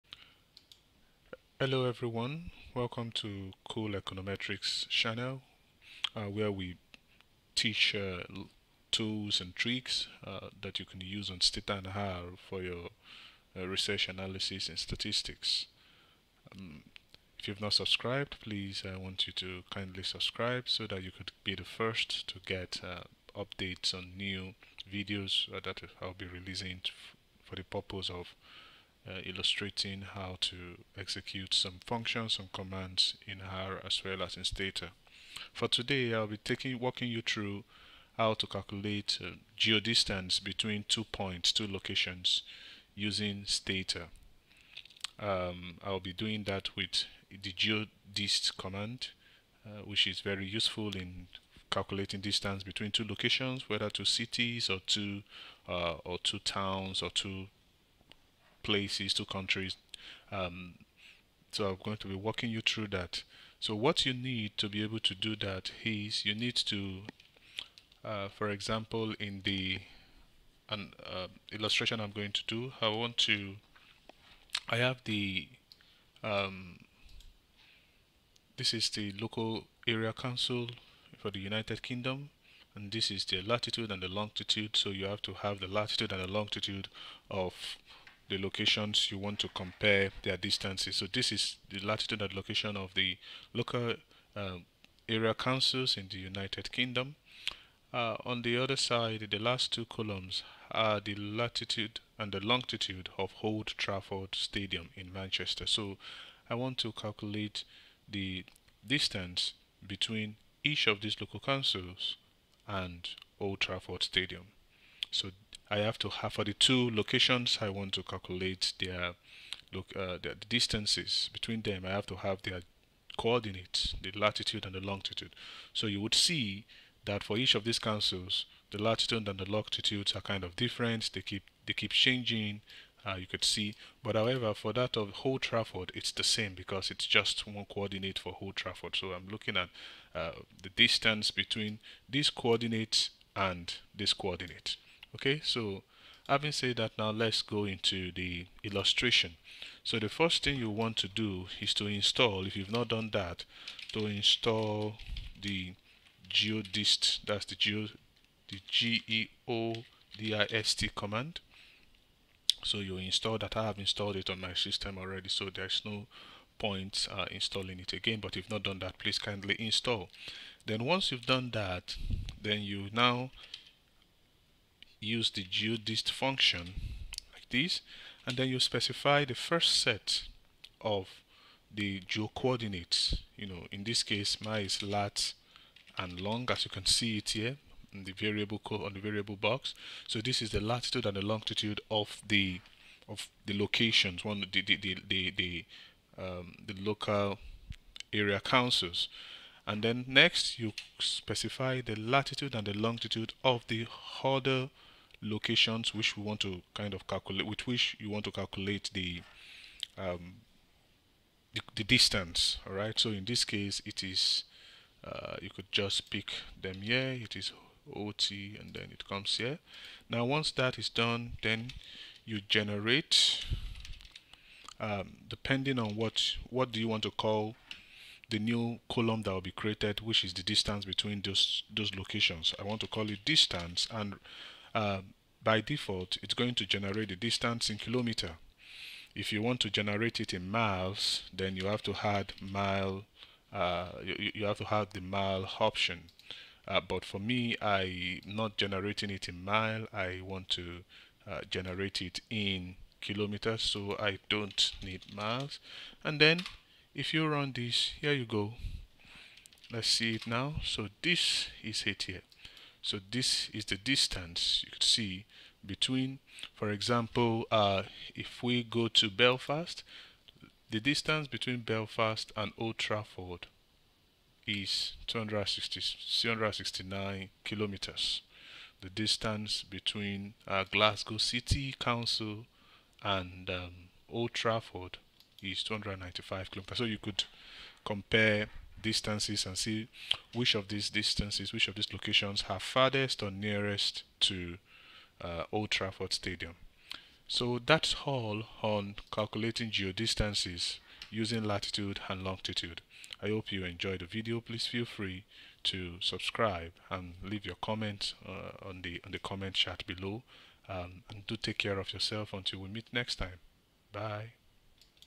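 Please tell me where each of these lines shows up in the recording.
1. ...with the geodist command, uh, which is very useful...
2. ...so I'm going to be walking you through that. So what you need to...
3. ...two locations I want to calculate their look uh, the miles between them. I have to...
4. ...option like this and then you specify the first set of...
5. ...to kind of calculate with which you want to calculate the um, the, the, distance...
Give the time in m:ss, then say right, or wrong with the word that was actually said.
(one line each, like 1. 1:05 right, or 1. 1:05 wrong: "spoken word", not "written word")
1. 0:46 right
2. 1:01 right
3. 1:56 wrong: "distances", not "miles"
4. 2:56 wrong: "function", not "option"
5. 3:26 right.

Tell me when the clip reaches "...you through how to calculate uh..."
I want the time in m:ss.
0:37.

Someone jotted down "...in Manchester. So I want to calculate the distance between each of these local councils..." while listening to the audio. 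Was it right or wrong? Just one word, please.
right.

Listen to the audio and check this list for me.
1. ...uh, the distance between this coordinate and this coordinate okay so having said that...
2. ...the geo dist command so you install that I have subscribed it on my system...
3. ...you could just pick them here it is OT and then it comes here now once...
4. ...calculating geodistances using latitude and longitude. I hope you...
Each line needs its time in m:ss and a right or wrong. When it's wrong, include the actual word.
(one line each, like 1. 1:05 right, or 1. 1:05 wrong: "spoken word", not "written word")
1. 2:20 right
2. 2:38 wrong: "installed", not "subscribed"
3. 3:35 right
4. 4:59 right.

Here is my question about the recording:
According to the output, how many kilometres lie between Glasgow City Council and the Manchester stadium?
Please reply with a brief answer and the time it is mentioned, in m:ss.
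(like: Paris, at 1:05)
295, at 4:45.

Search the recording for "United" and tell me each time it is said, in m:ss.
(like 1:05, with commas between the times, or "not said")
1:21, 1:36.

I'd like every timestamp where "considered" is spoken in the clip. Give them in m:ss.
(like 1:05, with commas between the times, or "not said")
not said.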